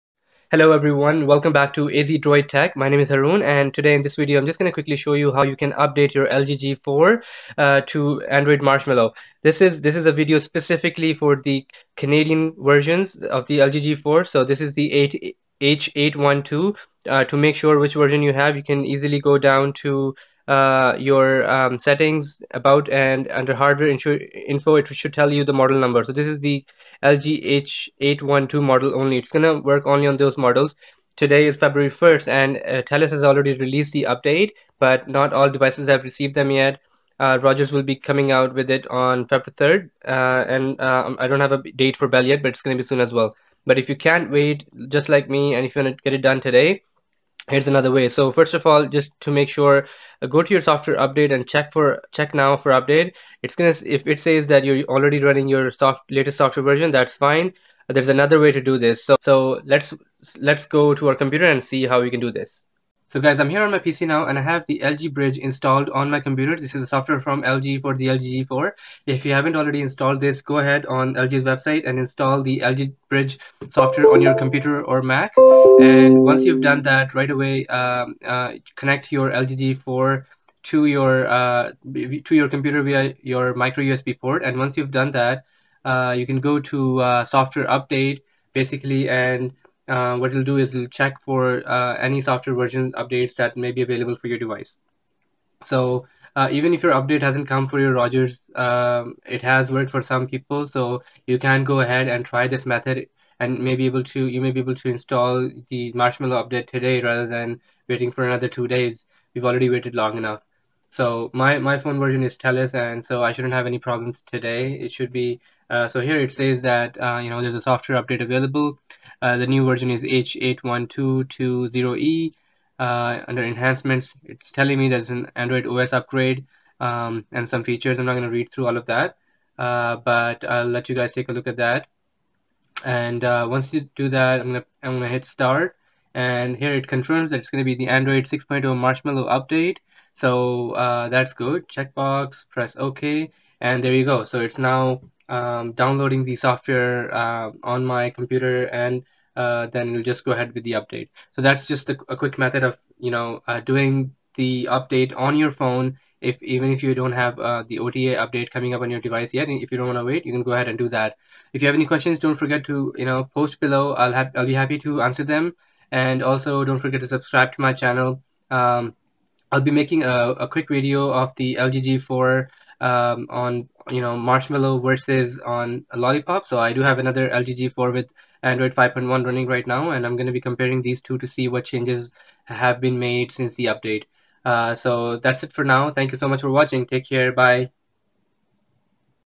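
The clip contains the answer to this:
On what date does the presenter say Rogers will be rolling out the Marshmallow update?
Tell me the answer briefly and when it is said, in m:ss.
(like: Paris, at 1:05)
February 3rd, at 0:39.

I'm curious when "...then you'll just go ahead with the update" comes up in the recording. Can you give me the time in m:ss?
2:29.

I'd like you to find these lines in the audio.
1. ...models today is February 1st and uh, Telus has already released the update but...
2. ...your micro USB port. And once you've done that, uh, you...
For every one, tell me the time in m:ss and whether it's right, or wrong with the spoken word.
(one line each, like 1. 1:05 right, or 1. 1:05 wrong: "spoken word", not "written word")
1. 0:30 right
2. 1:23 right.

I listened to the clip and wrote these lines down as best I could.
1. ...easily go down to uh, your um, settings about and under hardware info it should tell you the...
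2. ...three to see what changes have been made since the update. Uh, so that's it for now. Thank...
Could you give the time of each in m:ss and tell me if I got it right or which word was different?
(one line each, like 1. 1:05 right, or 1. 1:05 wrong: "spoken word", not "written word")
1. 0:18 right
2. 3:01 wrong: "two", not "three".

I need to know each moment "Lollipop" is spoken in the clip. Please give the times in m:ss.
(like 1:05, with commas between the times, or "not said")
2:55.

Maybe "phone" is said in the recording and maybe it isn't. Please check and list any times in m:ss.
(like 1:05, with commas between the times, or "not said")
1:51, 2:35.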